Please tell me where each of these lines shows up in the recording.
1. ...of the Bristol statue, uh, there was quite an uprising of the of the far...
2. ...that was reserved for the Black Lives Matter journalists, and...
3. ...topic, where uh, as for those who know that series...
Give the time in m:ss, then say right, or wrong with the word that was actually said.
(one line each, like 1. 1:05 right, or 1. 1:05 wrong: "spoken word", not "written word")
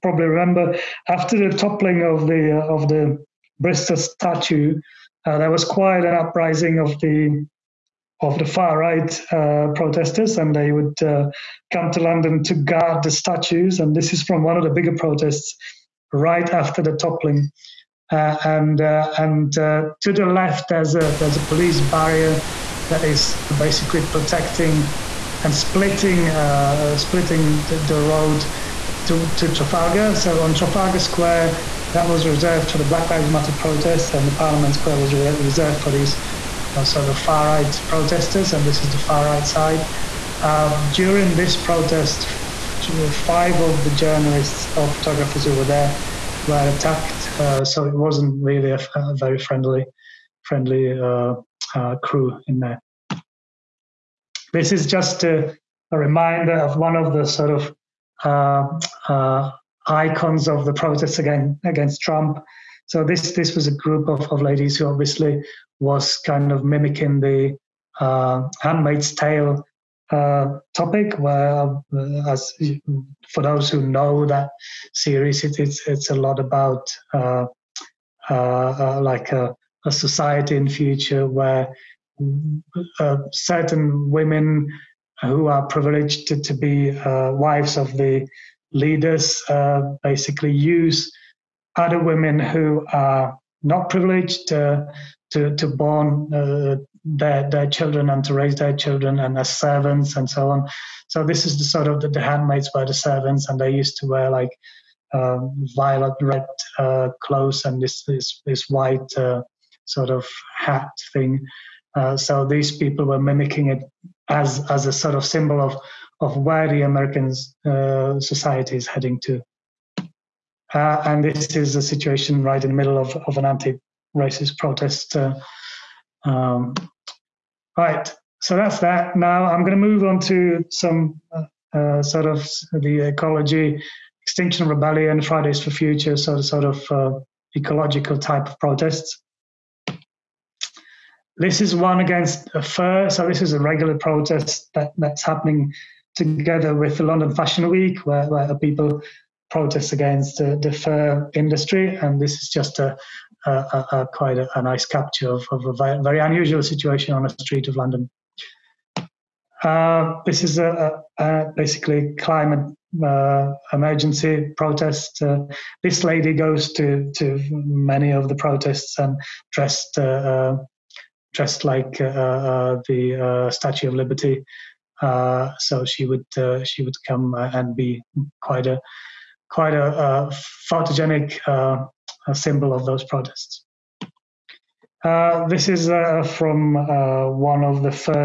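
1. 0:02 right
2. 0:31 wrong: "protests", not "journalists"
3. 1:10 right.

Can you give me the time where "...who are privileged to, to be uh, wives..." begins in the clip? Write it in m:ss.
1:25.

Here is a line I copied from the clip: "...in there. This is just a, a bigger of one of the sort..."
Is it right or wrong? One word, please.
wrong.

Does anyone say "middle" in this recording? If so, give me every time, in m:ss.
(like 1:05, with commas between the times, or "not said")
2:02.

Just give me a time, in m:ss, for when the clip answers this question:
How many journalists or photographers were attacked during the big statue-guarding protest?
0:43.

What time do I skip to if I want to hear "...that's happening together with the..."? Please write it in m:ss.
2:24.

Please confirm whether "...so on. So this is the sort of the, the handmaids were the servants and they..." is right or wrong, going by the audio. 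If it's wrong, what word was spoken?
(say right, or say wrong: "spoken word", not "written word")
right.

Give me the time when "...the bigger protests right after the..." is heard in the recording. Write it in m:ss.
0:14.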